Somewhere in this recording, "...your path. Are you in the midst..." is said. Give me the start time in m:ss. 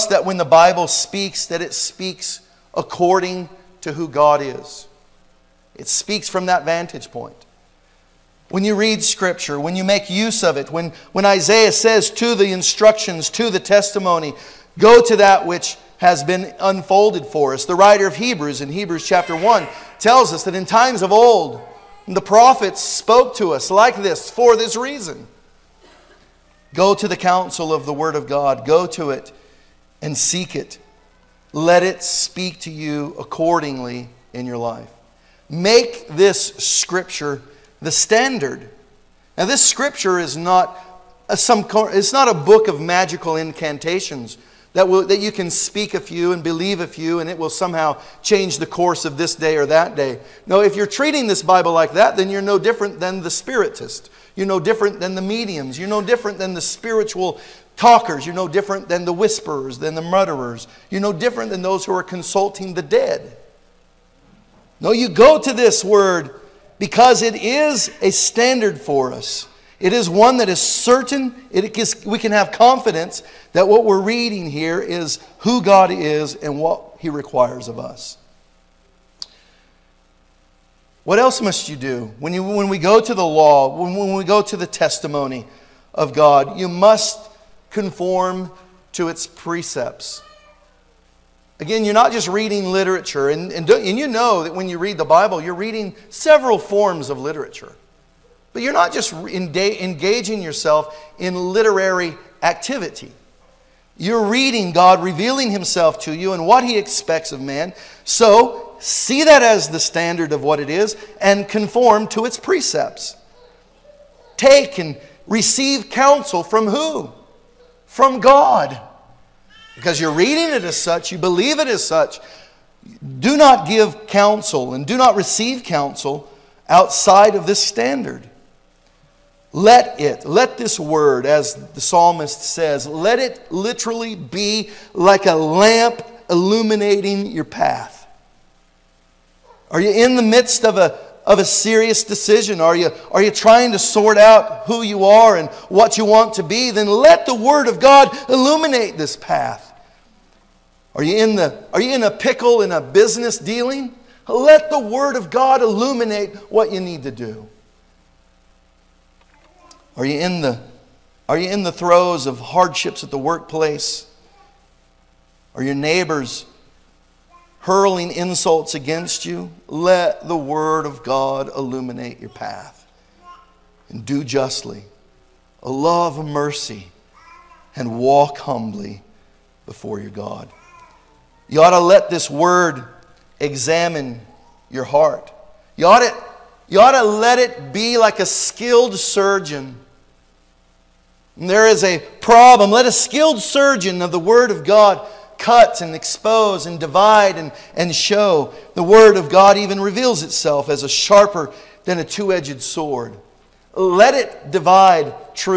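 2:17.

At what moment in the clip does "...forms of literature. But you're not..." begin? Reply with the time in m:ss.
1:36.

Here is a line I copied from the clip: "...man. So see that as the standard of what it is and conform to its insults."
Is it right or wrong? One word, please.
wrong.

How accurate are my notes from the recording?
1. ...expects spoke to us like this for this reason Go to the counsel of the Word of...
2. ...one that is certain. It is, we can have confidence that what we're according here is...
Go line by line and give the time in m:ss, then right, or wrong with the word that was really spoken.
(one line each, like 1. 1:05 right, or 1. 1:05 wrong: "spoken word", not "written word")
1. 0:22 wrong: "prophets", not "expects"
2. 1:10 wrong: "reading", not "according".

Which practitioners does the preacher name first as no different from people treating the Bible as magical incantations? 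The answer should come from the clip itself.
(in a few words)
The spiritist.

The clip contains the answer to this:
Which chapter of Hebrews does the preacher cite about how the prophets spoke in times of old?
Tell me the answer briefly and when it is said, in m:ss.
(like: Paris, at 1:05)
Chapter 1, at 0:18.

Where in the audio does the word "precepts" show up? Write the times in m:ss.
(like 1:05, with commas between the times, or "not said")
1:29, 1:52.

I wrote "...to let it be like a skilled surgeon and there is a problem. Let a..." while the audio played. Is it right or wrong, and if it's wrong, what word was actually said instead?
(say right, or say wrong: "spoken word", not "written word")
right.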